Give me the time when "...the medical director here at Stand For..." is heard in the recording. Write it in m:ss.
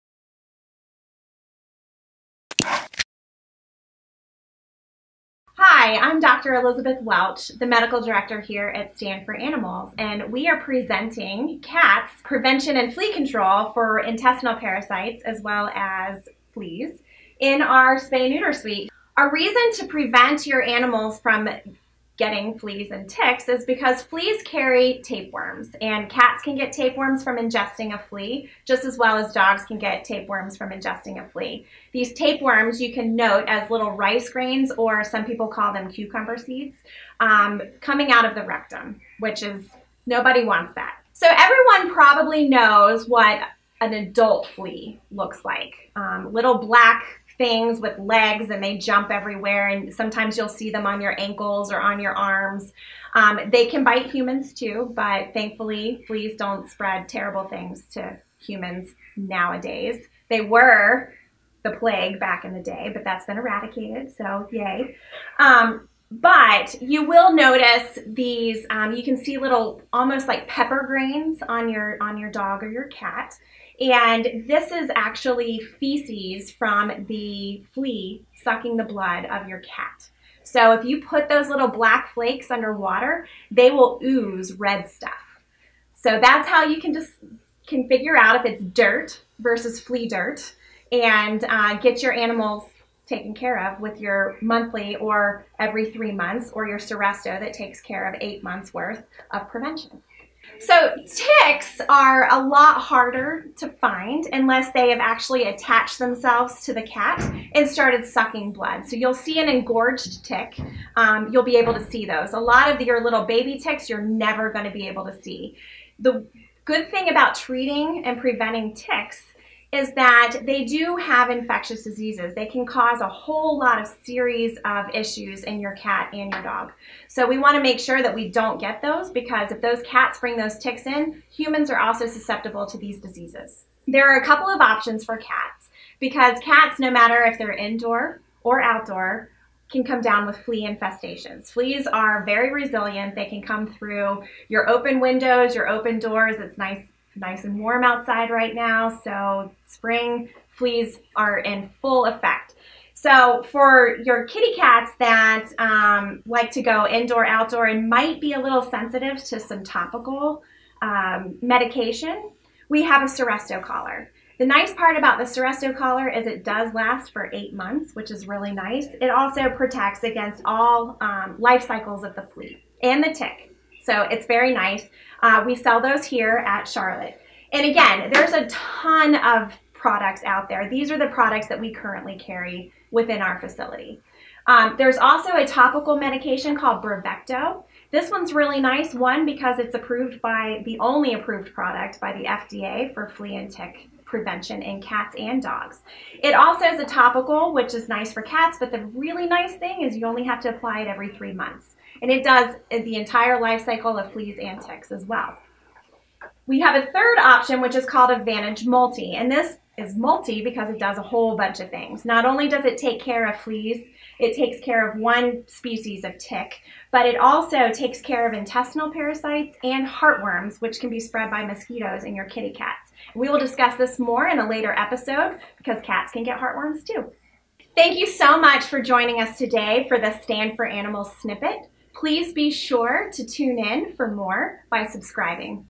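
0:07.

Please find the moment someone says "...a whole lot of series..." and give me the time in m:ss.
2:02.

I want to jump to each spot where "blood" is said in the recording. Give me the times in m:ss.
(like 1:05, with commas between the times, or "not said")
1:18, 1:48.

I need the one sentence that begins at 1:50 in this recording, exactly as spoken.
Um, you'll be able to see those.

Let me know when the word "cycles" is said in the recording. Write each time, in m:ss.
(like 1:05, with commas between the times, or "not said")
2:51, 3:23.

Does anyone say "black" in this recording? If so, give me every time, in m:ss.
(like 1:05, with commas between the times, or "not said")
0:46, 1:21.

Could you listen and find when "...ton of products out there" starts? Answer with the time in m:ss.
2:58.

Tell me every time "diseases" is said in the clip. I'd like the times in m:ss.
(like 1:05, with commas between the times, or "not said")
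2:01, 2:12.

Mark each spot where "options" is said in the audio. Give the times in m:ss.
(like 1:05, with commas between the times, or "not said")
2:14, 3:27.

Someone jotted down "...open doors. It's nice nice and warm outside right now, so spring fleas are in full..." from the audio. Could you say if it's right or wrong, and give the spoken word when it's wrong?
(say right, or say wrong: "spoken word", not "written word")
right.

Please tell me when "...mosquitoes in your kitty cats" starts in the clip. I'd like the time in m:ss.
3:41.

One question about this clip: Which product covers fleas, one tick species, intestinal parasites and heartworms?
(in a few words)
Advantage Multi.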